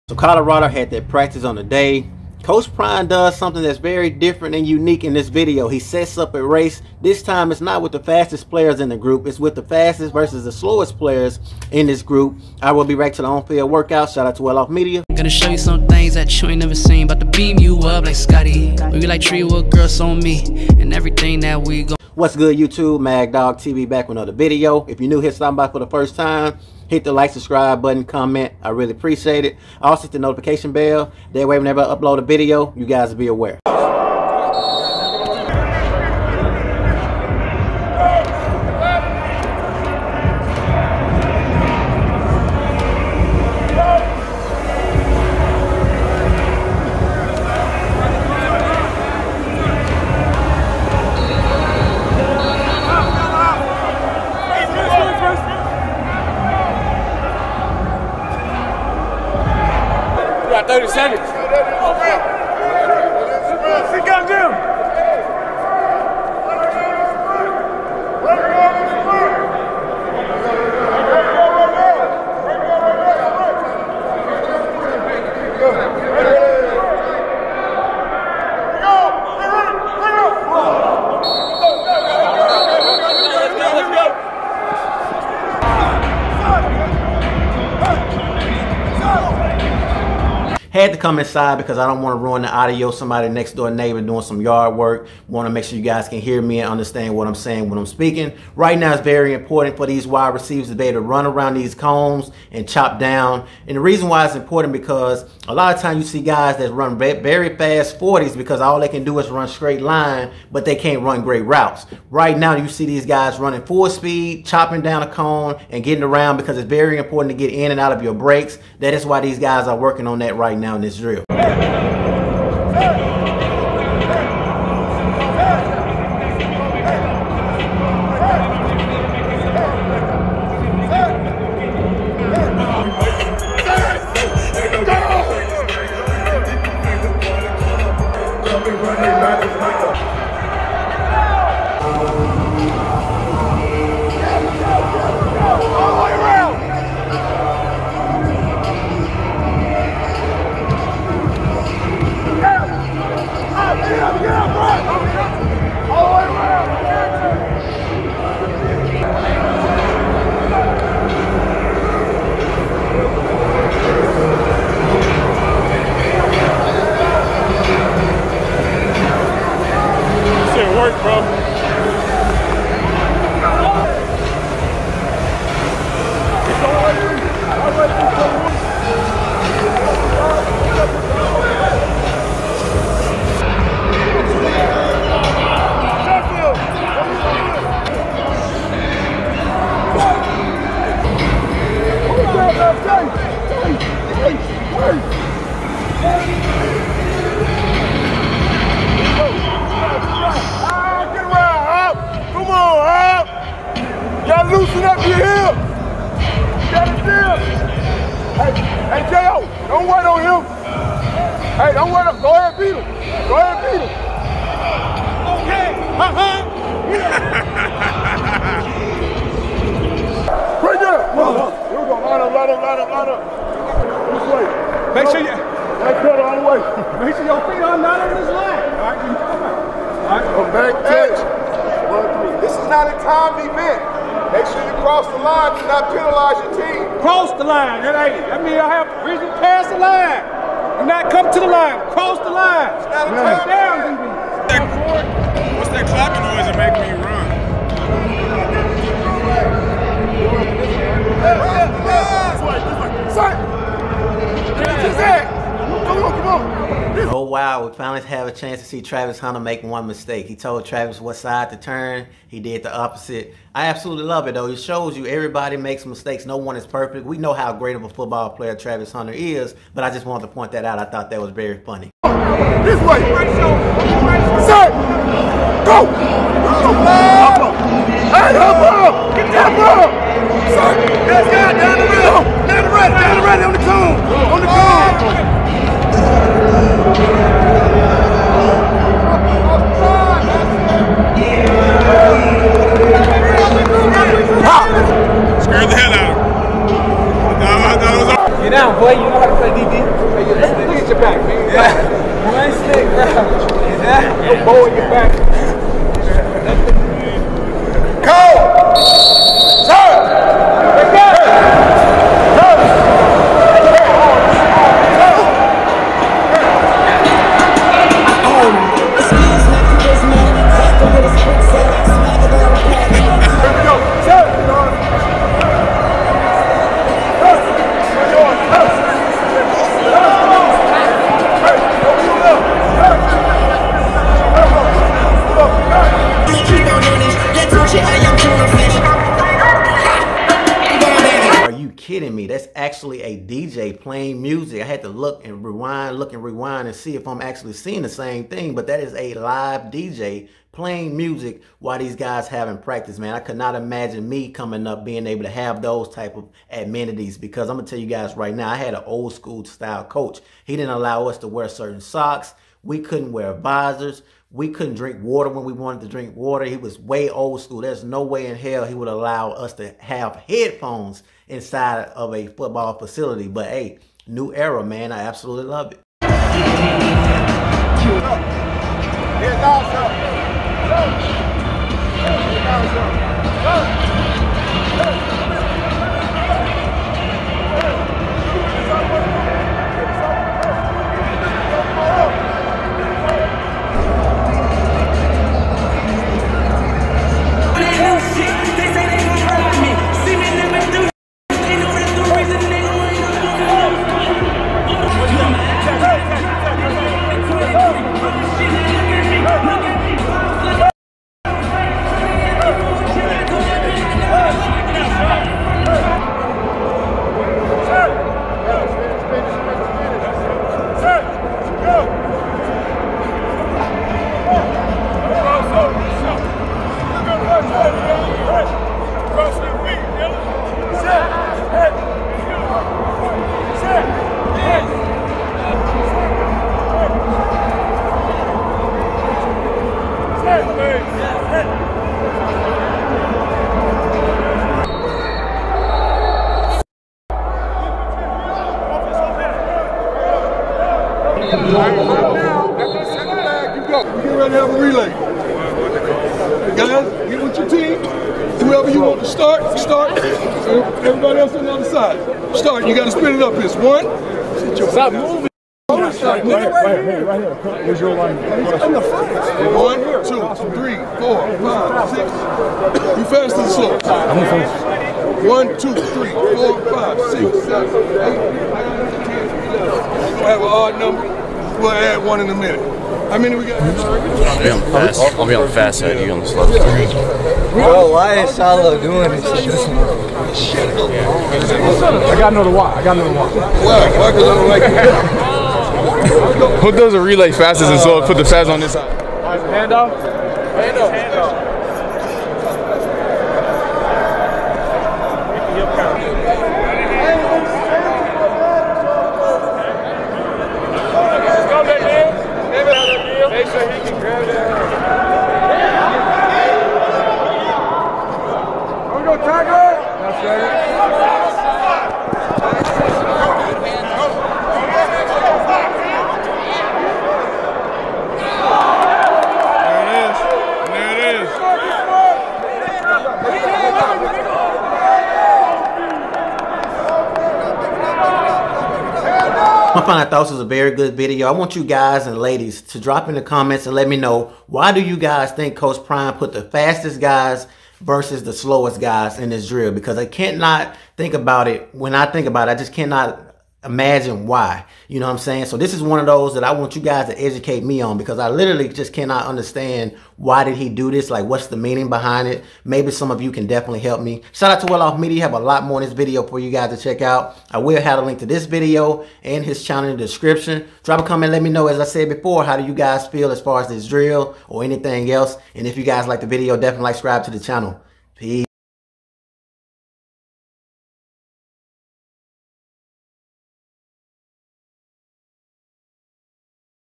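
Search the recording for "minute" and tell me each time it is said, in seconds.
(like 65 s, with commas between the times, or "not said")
482 s.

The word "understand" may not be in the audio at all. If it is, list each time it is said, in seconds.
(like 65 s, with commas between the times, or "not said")
96 s, 559 s.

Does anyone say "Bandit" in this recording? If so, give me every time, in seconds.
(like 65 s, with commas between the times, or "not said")
not said.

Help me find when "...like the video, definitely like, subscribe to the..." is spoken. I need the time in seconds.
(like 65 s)
576 s.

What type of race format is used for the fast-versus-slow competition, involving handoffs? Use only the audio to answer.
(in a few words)
A relay.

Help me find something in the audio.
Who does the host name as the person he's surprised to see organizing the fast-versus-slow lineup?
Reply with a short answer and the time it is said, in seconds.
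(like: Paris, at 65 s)
Shilo, at 488 s.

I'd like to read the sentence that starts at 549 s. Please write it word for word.
Because I cannot think about it.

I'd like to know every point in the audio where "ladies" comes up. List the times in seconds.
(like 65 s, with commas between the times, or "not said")
542 s.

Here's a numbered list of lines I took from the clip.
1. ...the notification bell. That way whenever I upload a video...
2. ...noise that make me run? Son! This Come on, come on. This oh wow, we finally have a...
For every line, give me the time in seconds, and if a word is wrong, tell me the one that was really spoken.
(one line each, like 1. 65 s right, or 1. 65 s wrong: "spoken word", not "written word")
1. 30 s right
2. 246 s right.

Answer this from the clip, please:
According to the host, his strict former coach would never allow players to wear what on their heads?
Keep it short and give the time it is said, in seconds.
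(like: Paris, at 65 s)
Visors, at 363 s.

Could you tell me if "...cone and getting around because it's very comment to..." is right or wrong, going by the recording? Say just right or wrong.
wrong.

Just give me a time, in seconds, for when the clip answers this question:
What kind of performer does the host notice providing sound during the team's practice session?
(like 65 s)
349 s.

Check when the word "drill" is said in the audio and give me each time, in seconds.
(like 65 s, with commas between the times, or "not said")
549 s, 573 s.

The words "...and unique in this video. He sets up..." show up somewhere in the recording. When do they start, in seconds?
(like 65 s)
4 s.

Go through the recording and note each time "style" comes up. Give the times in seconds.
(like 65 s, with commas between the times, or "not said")
359 s.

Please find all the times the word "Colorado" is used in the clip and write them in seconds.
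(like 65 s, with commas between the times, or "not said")
0 s.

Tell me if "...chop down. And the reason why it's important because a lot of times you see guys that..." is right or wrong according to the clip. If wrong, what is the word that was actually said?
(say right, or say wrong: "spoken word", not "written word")
right.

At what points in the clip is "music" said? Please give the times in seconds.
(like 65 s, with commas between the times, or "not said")
350 s.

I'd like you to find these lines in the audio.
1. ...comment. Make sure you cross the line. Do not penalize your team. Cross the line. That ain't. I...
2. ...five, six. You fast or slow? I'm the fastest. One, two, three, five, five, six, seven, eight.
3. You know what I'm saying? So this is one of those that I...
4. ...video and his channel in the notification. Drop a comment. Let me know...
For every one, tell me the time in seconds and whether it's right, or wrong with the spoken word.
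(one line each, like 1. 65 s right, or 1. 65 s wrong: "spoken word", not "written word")
1. 233 s wrong: "event", not "comment"
2. 471 s wrong: "four", not "five"
3. 554 s right
4. 568 s wrong: "description", not "notification".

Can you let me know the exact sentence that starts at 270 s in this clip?
I thought that was very funny.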